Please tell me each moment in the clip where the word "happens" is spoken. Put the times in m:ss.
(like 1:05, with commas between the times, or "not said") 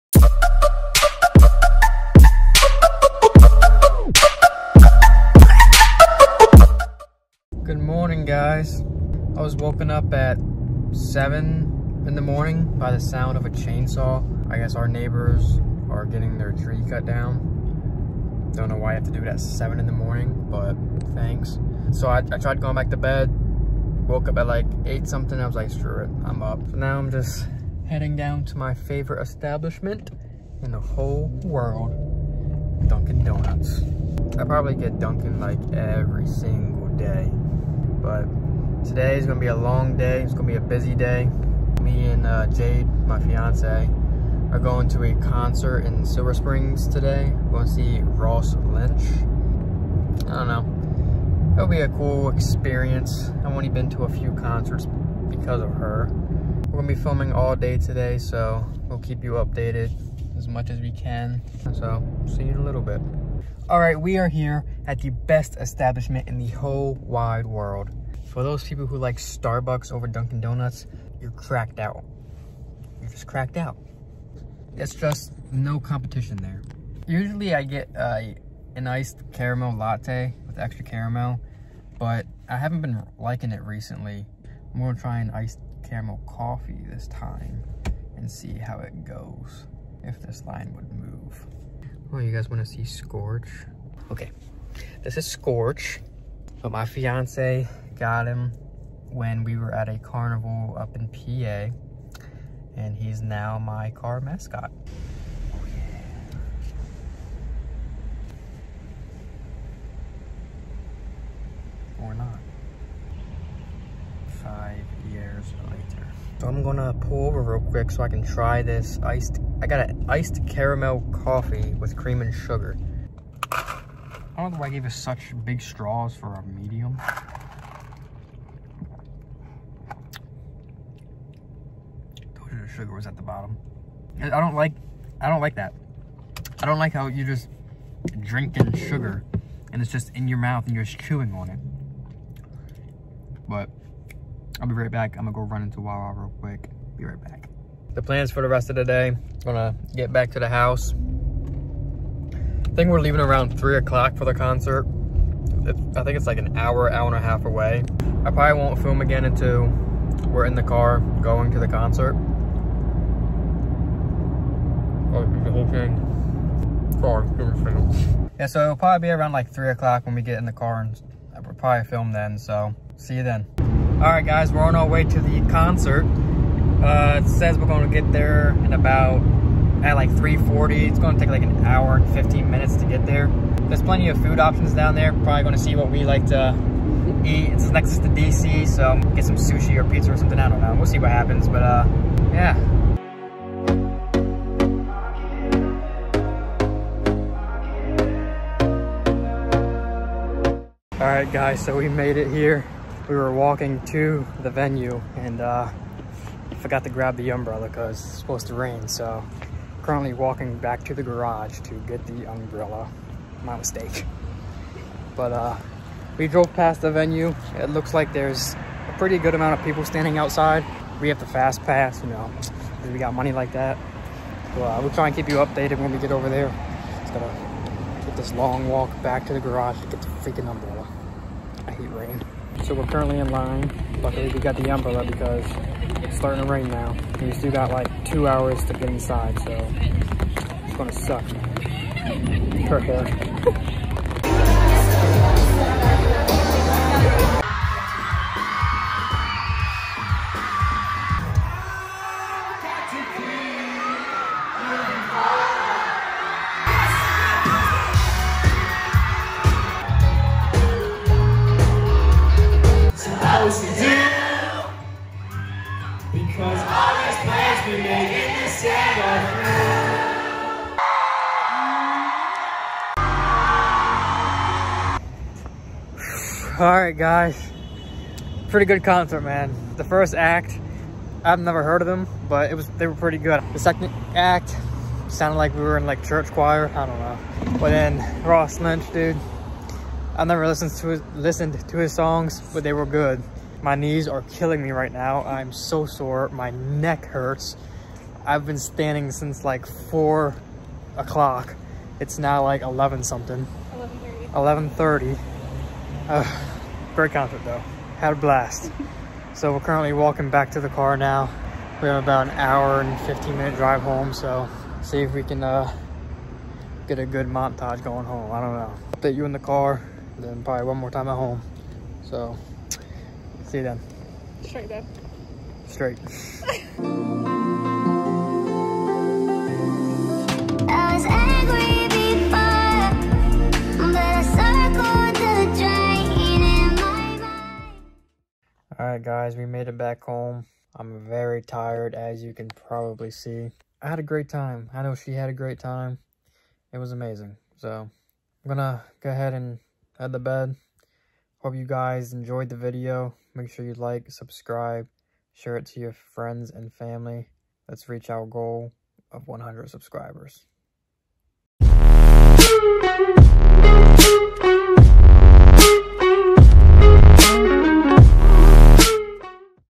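3:11.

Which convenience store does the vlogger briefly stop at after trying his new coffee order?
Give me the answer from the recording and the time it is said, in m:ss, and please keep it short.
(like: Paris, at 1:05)
Wawa, at 2:25.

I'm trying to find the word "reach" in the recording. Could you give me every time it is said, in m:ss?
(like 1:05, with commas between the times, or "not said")
5:57.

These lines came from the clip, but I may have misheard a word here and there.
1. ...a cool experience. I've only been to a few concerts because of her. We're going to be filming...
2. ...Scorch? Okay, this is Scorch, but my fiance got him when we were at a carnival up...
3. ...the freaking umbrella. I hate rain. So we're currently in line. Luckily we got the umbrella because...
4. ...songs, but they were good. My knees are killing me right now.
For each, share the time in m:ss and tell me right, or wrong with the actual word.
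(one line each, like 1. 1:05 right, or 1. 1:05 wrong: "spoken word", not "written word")
1. 0:51 right
2. 1:32 right
3. 3:50 right
4. 4:51 right.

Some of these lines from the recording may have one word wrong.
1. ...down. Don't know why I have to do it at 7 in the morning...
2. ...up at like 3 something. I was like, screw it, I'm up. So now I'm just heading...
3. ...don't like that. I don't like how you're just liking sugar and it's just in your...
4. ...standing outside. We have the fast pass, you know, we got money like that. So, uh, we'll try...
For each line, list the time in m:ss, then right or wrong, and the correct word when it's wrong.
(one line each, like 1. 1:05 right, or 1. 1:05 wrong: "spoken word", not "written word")
1. 0:17 right
2. 0:24 wrong: "8", not "3"
3. 2:15 wrong: "drinking", not "liking"
4. 3:39 right.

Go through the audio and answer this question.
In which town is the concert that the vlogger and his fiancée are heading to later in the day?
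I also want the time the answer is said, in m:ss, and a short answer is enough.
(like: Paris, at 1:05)
Silver Springs, at 0:46.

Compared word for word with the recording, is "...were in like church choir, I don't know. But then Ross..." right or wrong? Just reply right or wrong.
right.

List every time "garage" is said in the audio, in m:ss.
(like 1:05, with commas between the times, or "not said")
3:31, 3:49.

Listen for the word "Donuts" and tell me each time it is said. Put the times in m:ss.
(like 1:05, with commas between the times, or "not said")
0:33, 1:10.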